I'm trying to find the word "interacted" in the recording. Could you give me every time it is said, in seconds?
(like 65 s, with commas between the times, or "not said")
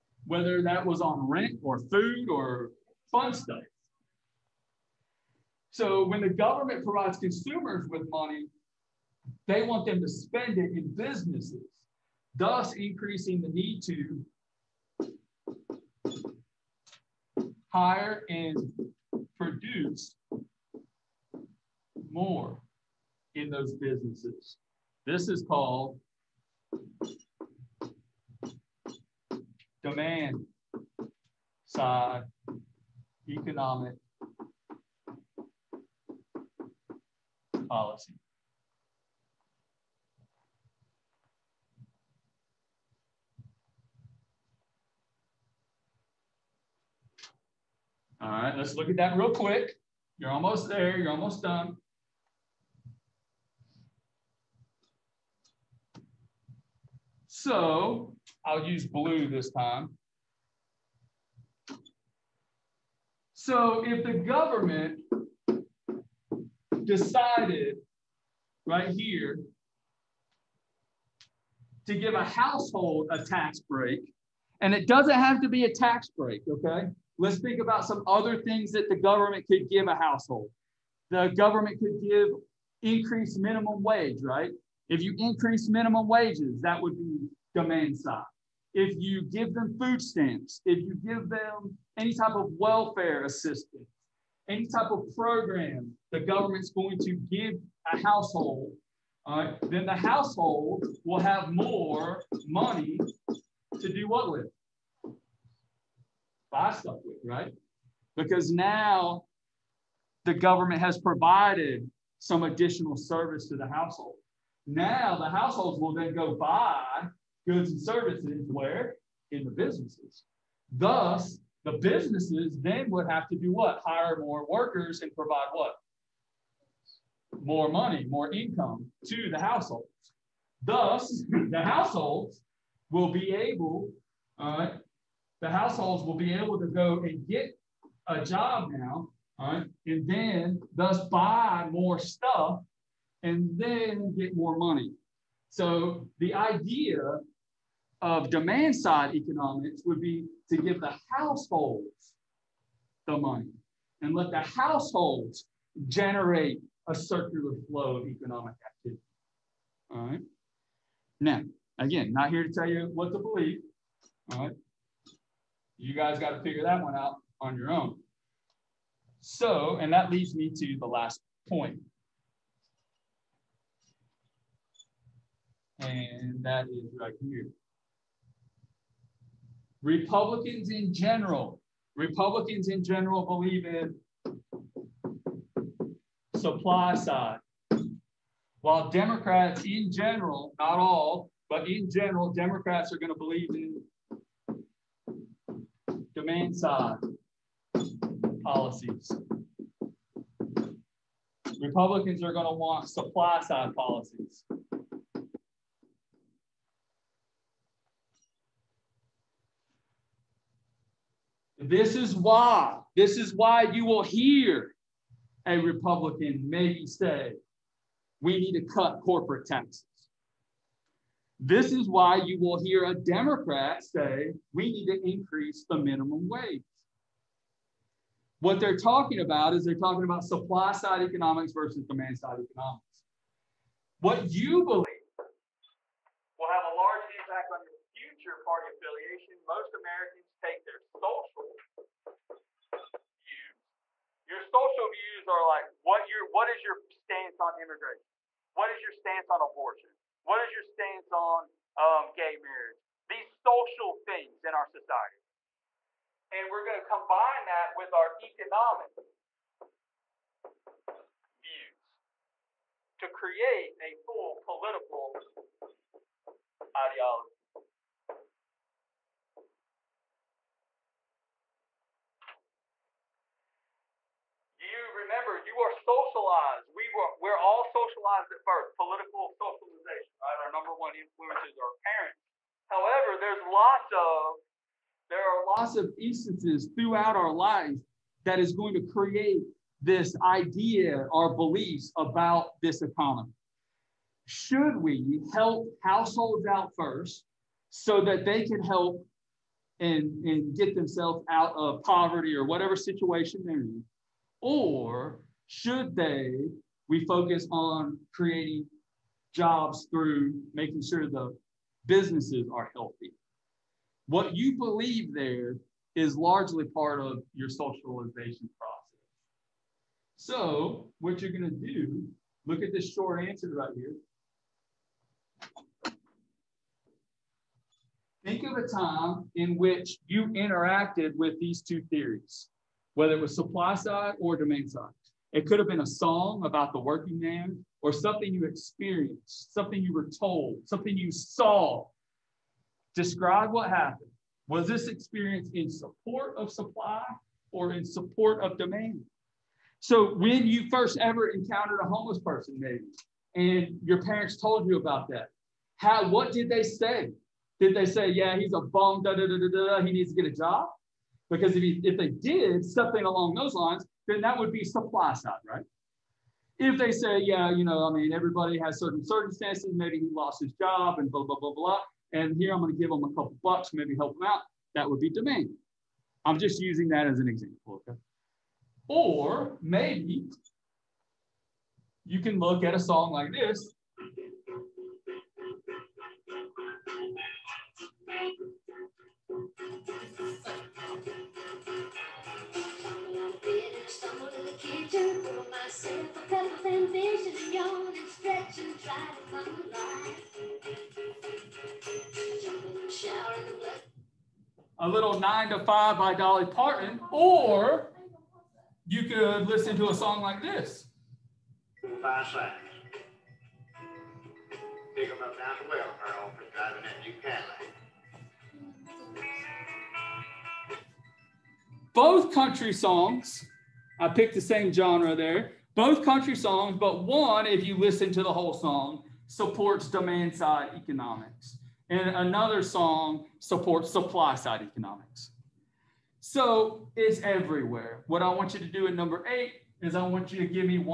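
330 s.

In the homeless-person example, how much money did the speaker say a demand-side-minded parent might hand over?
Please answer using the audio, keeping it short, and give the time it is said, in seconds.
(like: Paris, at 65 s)
A couple bucks, at 373 s.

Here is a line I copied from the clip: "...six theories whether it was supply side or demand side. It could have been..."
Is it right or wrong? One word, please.
wrong.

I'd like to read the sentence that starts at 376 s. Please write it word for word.
I'm just using that as an example, okay?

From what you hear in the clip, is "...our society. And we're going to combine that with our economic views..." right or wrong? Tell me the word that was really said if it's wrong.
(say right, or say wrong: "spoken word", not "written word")
right.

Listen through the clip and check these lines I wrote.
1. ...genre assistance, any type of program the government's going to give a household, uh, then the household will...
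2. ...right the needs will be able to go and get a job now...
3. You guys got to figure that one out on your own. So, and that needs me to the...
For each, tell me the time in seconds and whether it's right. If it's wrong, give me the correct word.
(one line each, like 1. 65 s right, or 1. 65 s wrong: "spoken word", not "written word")
1. 92 s wrong: "welfare", not "genre"
2. 134 s wrong: "households", not "needs"
3. 165 s wrong: "leads", not "needs".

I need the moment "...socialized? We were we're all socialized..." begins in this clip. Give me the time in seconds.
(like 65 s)
275 s.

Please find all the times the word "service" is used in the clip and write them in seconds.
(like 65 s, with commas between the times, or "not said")
112 s, 117 s.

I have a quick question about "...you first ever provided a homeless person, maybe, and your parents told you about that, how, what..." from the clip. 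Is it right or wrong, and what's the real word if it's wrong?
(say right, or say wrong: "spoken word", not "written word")
wrong: "encountered", not "provided".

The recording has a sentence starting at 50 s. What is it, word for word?
You're almost there, you're almost done.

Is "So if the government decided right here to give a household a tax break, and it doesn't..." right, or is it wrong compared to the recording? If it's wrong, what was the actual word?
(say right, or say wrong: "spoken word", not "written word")
right.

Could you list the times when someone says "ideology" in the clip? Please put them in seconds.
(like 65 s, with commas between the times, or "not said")
266 s.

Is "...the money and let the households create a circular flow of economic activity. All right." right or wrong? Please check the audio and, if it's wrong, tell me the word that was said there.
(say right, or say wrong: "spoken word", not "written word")
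wrong: "generate", not "create".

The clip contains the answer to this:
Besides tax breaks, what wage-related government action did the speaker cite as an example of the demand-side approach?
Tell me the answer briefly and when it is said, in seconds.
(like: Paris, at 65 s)
Increased minimum wage, at 82 s.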